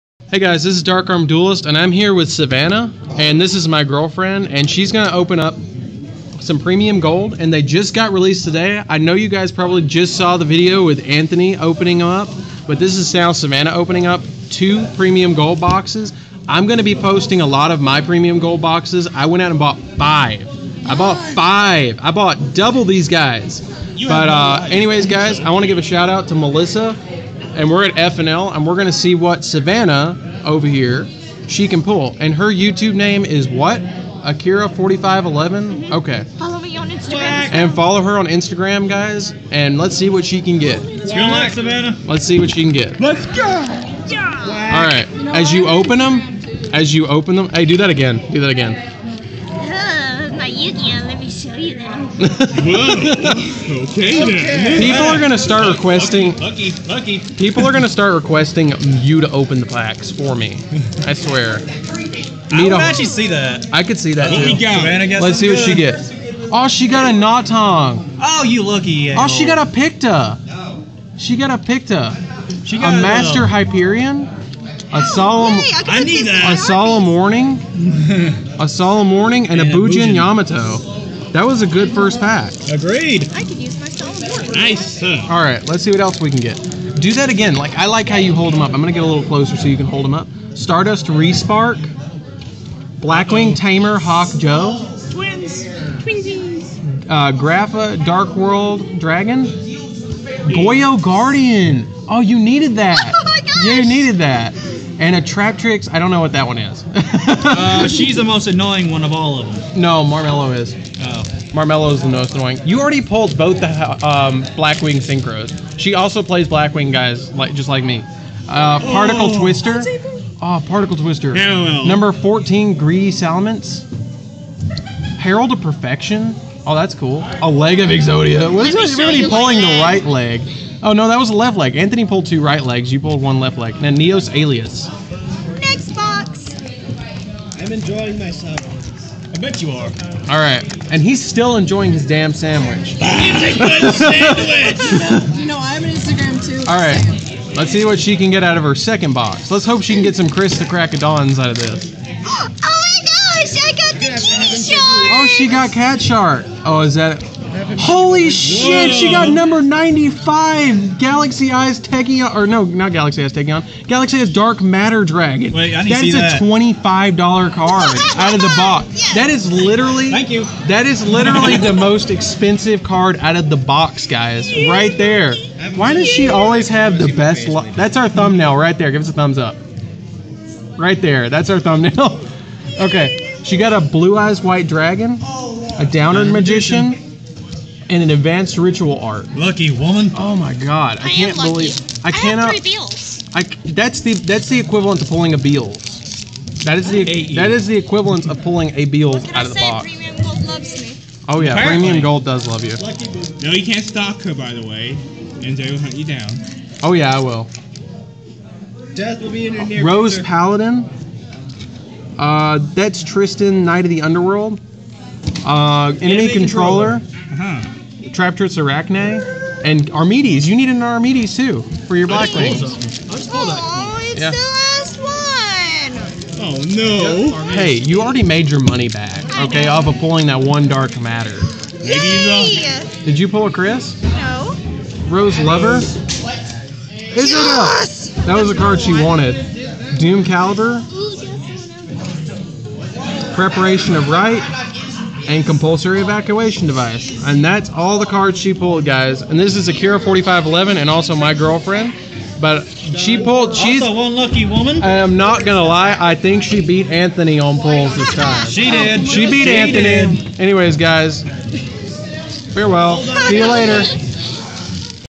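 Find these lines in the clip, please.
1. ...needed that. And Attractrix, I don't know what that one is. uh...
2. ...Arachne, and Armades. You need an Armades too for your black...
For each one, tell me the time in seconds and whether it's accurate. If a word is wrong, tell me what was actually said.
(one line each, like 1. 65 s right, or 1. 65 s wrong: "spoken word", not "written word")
1. 103 s right
2. 218 s right.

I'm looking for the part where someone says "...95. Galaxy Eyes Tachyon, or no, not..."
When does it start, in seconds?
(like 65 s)
159 s.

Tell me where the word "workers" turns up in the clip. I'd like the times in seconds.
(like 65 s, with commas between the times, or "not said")
not said.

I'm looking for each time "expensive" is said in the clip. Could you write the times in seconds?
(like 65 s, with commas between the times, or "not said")
172 s.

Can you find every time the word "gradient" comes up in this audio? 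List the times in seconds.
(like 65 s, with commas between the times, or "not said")
not said.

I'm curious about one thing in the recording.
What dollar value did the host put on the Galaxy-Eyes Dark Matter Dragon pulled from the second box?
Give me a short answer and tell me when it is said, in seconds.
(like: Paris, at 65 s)
$25, at 166 s.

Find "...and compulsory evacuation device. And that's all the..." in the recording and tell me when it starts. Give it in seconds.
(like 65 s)
245 s.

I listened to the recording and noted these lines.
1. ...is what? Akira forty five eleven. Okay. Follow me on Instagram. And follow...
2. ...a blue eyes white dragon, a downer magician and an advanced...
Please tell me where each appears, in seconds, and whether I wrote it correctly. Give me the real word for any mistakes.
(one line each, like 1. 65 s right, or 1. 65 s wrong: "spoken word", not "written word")
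1. 33 s right
2. 183 s right.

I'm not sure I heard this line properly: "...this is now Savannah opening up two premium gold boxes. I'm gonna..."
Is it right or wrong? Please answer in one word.
right.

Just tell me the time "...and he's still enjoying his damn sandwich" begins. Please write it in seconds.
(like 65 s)
140 s.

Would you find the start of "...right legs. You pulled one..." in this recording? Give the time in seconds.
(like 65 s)
132 s.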